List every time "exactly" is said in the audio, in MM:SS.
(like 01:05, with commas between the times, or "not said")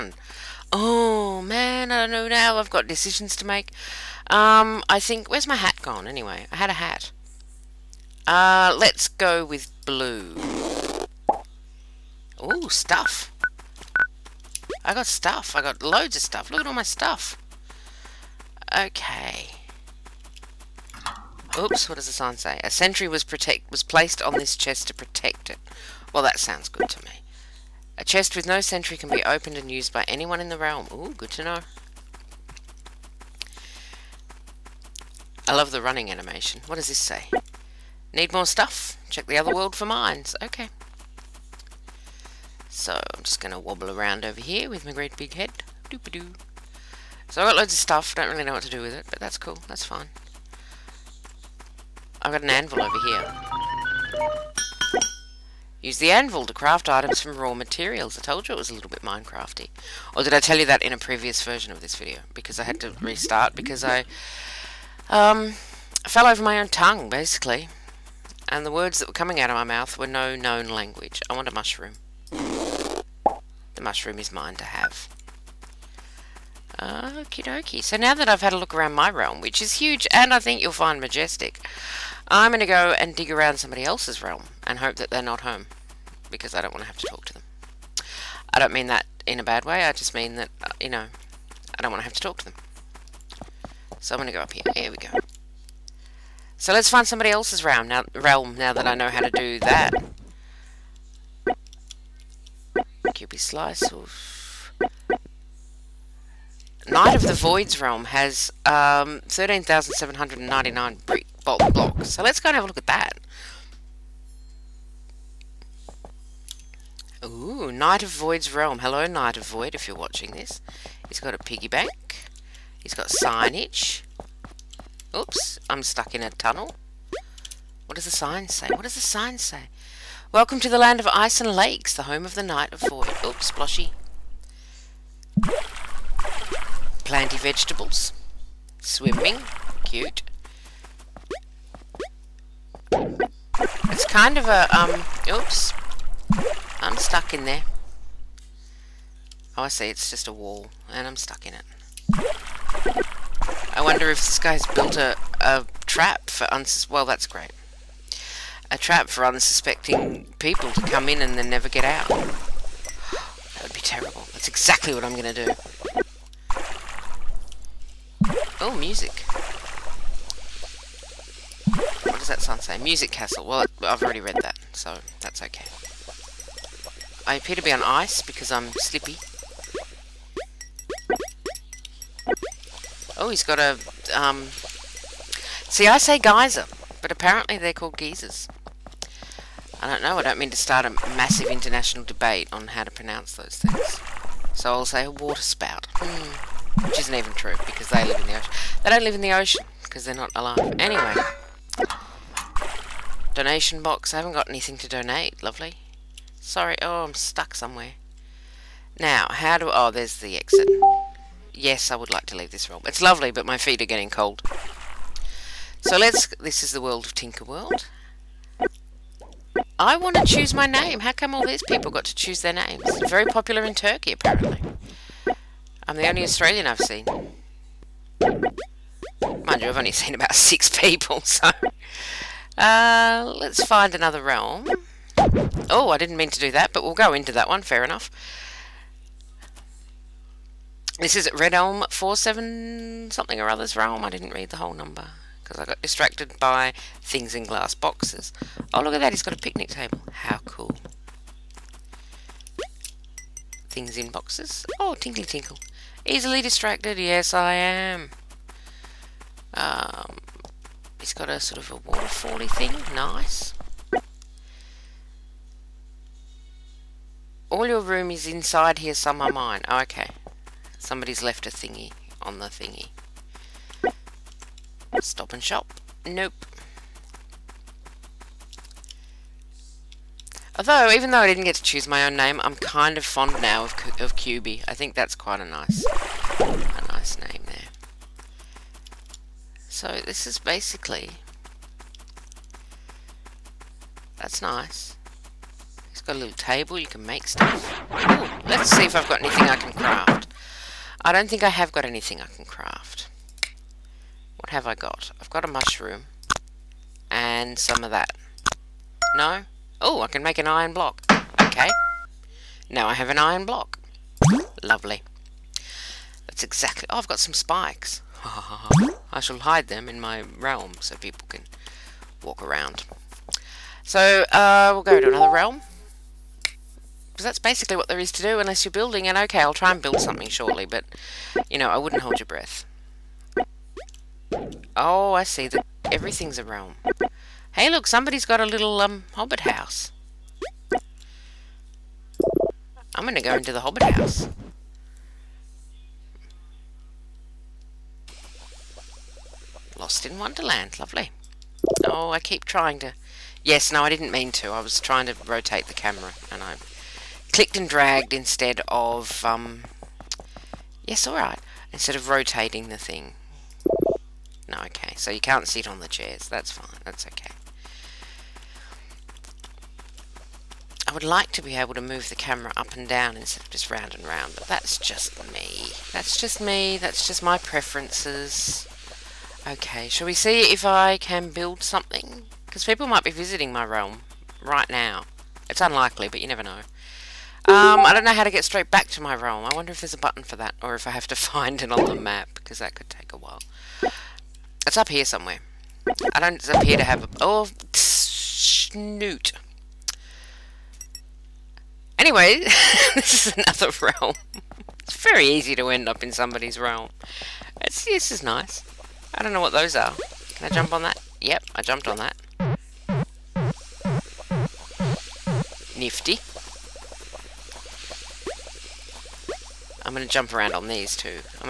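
02:44, 05:16.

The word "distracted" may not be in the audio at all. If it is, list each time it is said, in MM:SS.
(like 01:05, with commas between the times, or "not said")
04:05, 04:16.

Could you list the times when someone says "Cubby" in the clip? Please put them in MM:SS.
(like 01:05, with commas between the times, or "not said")
01:43.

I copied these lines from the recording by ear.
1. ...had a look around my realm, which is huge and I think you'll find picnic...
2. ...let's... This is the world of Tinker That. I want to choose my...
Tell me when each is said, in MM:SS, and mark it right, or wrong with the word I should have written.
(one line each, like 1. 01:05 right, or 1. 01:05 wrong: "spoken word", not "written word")
1. 01:18 wrong: "majestic", not "picnic"
2. 03:35 wrong: "World", not "That".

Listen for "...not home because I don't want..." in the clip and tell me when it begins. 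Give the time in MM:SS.
01:25.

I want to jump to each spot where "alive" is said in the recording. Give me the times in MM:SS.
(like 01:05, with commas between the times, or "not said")
03:20.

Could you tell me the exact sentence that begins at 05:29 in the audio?
And okay, I'll try and build something shortly, but, you know, I wouldn't hold your breath.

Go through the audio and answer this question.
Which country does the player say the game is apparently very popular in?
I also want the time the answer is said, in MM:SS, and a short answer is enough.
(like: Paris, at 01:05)
Turkey, at 03:43.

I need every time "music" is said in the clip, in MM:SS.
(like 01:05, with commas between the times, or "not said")
02:48, 02:52.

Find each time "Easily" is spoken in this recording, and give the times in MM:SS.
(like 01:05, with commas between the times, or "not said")
04:16.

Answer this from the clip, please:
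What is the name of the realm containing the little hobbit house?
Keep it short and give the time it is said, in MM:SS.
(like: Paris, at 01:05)
Lost in Wonderland, at 05:49.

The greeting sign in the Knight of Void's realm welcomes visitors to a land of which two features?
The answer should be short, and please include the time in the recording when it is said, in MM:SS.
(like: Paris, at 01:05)
Ice and lakes, at 02:11.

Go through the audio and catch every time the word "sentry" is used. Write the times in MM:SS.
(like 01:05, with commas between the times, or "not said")
00:22, 00:28.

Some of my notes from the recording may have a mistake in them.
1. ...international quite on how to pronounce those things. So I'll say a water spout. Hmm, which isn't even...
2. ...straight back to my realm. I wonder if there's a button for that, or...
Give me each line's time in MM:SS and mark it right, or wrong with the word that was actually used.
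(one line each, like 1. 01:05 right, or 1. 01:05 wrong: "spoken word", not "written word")
1. 03:11 wrong: "debate", not "quite"
2. 06:28 right.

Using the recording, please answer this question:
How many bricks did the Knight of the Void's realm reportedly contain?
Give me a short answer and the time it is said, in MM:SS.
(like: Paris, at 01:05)
13,799, at 01:49.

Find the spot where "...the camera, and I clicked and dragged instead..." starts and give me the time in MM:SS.
05:55.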